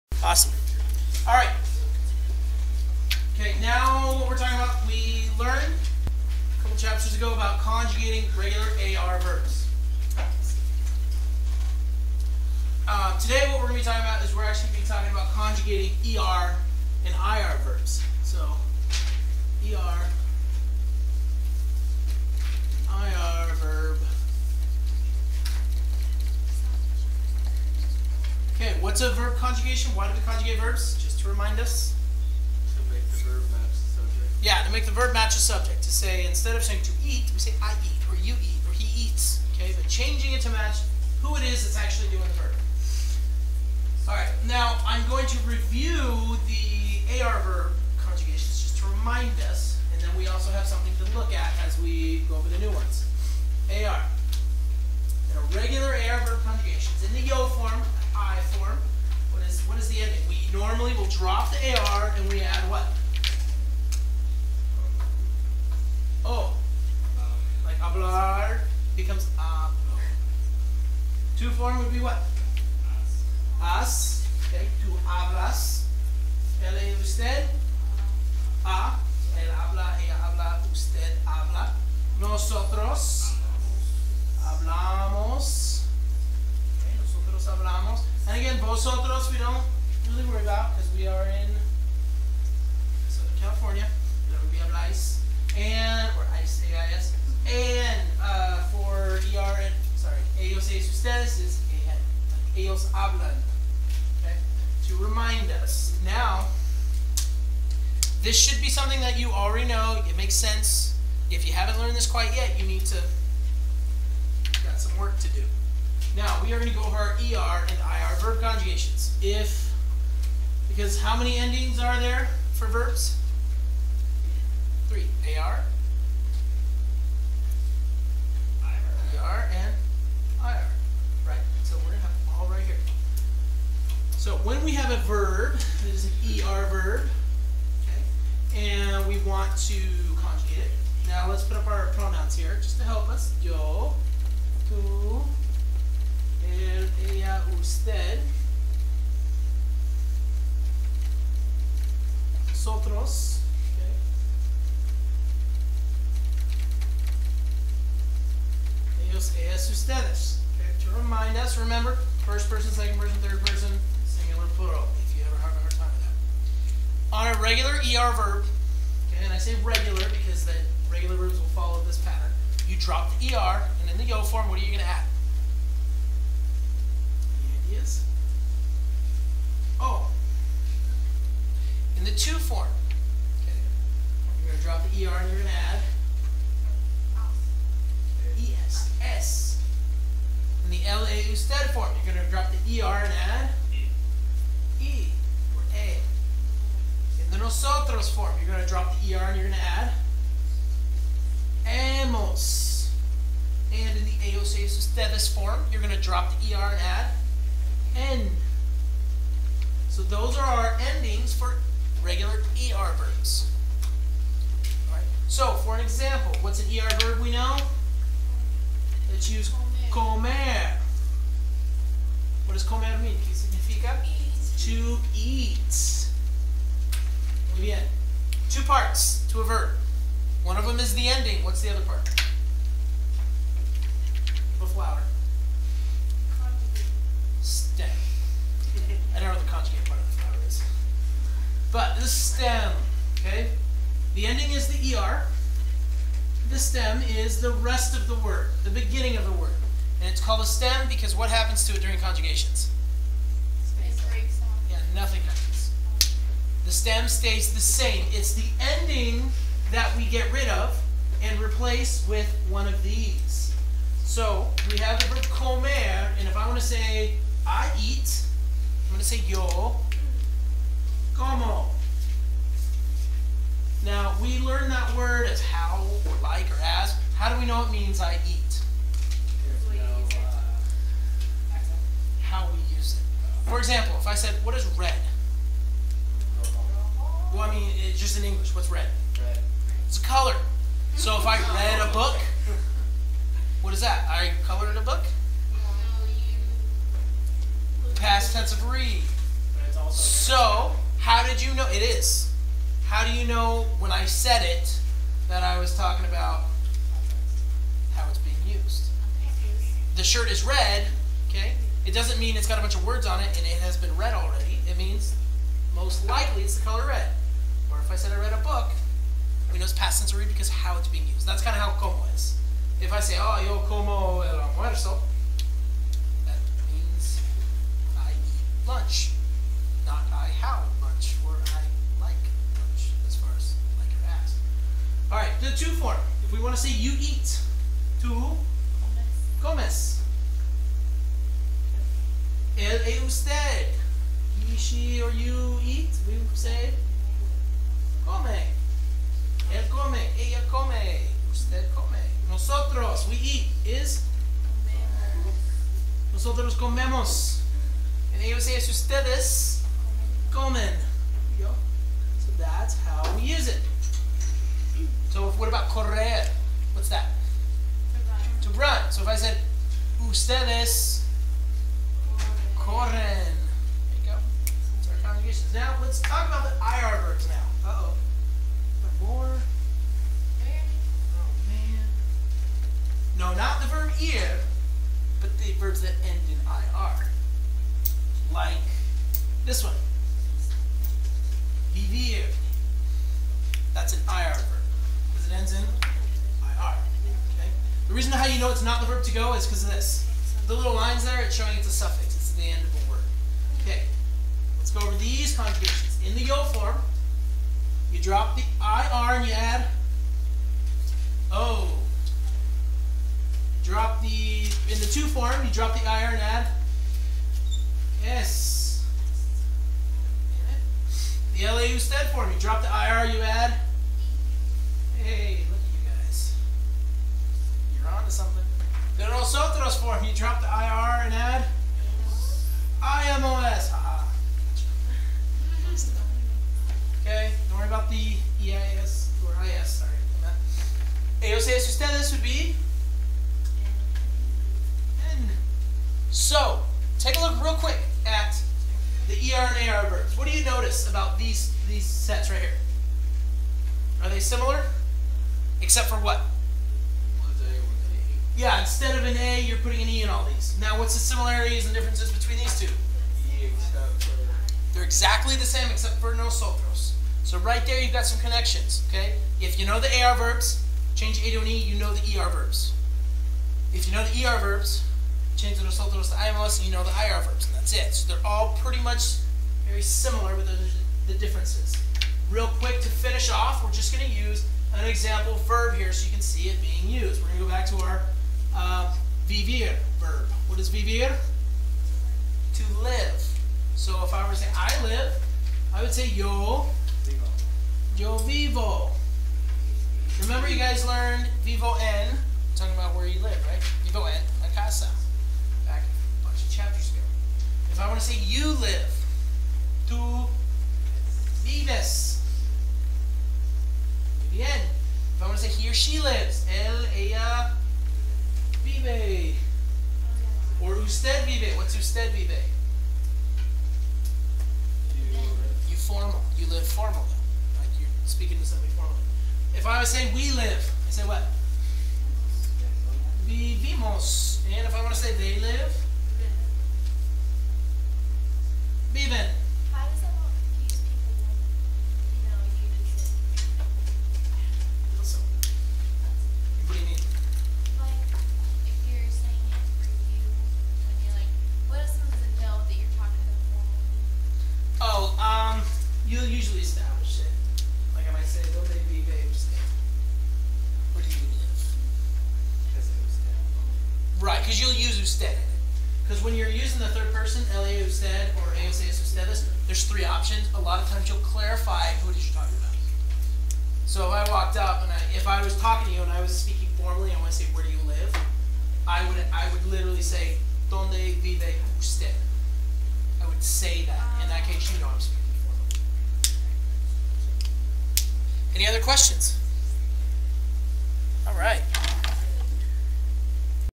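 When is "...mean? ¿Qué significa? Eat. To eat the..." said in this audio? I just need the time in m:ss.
3:42.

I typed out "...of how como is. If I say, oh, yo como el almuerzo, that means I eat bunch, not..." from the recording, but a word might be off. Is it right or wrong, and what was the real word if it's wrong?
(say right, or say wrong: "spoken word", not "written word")
wrong: "lunch", not "bunch".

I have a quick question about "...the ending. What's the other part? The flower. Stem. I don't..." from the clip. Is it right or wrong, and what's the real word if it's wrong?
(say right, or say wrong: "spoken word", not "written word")
right.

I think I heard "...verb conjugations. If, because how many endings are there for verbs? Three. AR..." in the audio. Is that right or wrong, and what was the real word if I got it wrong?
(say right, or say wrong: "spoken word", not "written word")
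right.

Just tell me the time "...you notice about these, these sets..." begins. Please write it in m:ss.
7:30.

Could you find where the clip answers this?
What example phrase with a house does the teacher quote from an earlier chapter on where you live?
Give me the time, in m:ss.
8:23.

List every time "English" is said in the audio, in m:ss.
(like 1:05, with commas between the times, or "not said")
4:48.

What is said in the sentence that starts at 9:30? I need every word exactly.
A lot of times you'll clarify who it is you're talking about.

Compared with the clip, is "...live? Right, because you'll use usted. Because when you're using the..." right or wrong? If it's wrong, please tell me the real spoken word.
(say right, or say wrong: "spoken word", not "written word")
right.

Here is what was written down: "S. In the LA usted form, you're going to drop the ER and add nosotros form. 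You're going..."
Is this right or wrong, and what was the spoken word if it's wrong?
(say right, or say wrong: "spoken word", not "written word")
right.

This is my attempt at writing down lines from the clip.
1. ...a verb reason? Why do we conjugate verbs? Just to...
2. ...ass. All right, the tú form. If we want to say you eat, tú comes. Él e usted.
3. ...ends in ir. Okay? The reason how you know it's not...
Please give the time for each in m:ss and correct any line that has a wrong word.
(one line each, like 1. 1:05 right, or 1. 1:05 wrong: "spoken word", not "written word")
1. 0:29 wrong: "conjugation", not "reason"
2. 5:34 right
3. 6:35 right.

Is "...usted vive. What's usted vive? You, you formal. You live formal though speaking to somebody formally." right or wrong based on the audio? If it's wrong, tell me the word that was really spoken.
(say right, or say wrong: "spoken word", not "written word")
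right.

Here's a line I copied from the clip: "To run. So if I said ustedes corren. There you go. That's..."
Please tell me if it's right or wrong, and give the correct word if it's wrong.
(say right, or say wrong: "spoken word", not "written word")
right.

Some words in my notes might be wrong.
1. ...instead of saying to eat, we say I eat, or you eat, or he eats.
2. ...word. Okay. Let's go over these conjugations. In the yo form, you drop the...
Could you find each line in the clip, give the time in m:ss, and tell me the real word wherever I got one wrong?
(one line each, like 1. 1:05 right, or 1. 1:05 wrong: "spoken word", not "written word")
1. 0:36 right
2. 6:42 right.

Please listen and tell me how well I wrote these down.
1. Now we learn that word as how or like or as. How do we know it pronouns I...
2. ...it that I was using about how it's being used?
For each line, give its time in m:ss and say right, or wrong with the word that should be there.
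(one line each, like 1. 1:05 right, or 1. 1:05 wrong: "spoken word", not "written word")
1. 4:33 wrong: "means", not "pronouns"
2. 5:04 wrong: "talking", not "using".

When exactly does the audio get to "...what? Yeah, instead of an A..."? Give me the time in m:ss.
7:35.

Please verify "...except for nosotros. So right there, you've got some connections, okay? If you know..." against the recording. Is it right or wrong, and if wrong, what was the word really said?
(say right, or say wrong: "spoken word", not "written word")
right.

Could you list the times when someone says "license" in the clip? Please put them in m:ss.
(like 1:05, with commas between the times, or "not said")
not said.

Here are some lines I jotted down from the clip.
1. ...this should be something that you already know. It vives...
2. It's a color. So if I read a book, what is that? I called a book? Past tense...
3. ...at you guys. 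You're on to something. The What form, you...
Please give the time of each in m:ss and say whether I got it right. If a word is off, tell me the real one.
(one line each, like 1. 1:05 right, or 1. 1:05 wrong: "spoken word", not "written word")
1. 1:48 wrong: "makes", not "vives"
2. 4:49 wrong: "colored", not "called"
3. 7:05 wrong: "Nosotros", not "What".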